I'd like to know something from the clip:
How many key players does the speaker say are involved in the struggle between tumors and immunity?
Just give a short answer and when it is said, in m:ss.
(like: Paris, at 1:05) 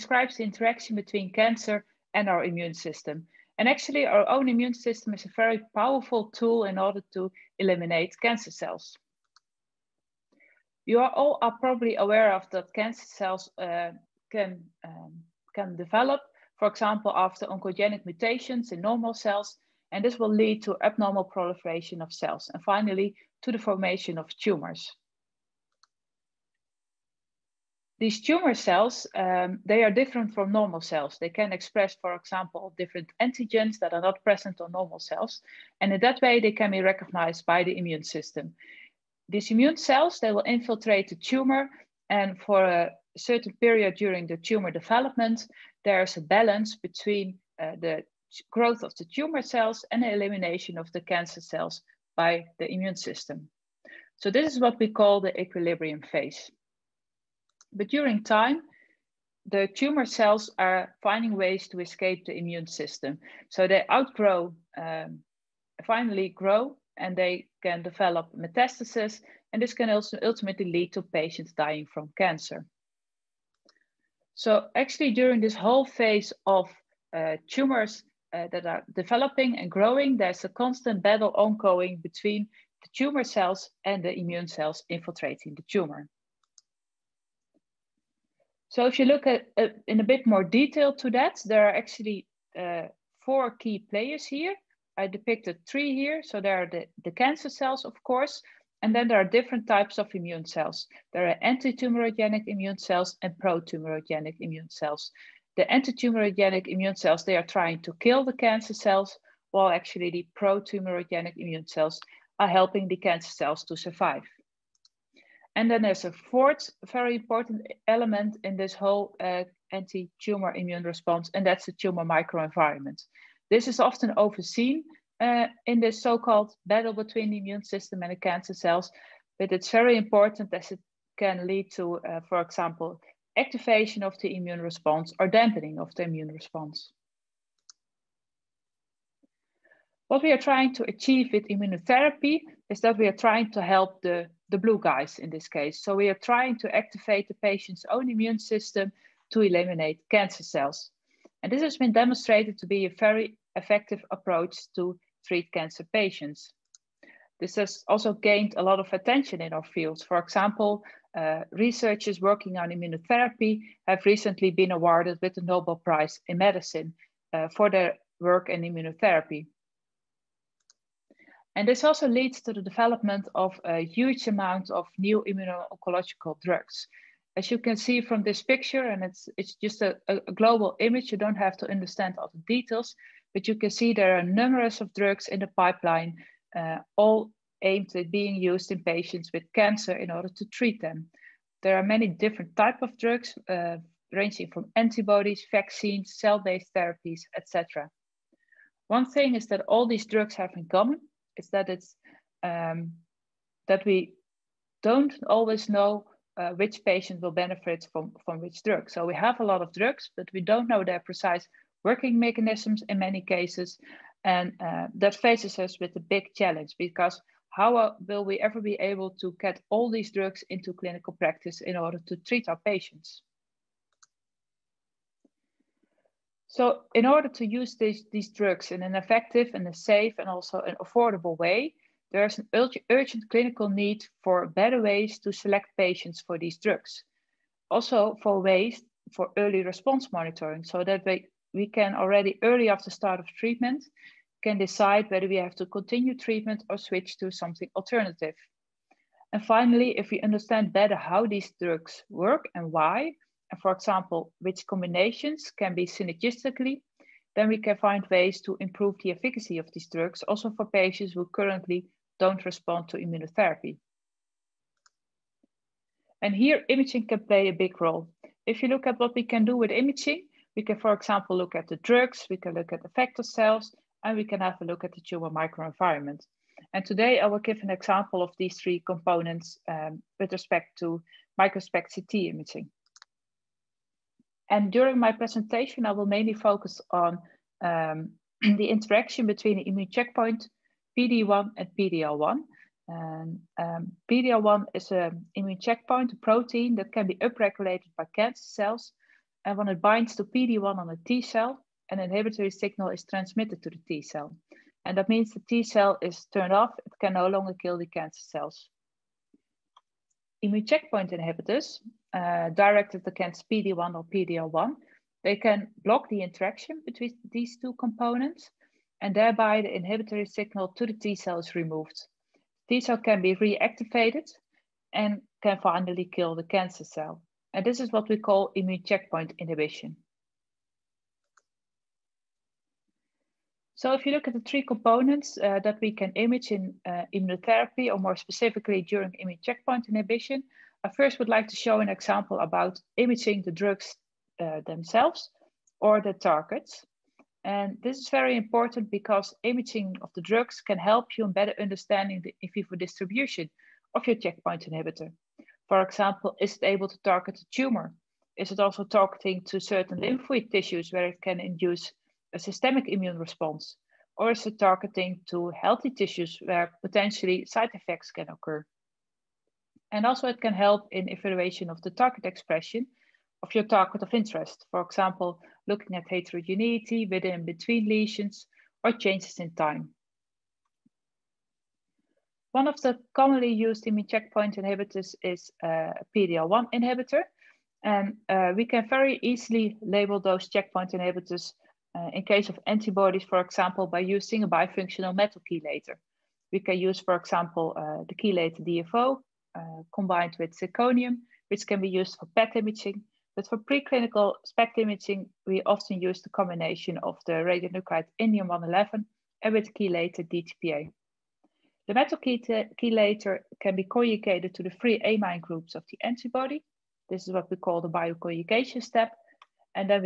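4, at 1:33.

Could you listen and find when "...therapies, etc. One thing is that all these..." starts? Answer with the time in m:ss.
3:16.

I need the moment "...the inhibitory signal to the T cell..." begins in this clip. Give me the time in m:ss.
5:19.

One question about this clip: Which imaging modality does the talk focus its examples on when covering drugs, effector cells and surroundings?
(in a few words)
microSPECT CT.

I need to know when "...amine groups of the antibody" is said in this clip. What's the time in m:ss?
6:55.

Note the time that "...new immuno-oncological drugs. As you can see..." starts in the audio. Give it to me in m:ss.
2:54.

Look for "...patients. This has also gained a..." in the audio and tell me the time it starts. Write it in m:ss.
2:35.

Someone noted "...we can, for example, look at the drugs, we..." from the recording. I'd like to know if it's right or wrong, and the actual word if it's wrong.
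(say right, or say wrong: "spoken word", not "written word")
right.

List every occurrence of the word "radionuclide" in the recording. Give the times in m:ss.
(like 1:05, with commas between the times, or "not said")
6:47.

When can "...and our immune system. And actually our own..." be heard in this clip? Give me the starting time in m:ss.
0:02.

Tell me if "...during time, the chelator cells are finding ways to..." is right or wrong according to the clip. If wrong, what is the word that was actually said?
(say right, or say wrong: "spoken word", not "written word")
wrong: "tumor", not "chelator".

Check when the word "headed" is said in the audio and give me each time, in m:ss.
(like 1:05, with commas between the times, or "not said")
not said.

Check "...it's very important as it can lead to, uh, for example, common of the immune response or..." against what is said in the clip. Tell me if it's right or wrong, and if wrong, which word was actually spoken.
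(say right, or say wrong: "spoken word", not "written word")
wrong: "activation", not "common".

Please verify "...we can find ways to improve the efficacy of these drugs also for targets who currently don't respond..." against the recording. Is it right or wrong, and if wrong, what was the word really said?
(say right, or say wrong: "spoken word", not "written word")
wrong: "patients", not "targets".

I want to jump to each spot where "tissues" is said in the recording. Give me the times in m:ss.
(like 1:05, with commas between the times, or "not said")
6:00, 6:05.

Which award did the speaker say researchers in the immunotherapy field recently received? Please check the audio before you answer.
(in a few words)
Nobel Prize in Medicine.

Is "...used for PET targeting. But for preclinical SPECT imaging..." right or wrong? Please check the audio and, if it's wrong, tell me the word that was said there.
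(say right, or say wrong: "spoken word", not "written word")
wrong: "imaging", not "targeting".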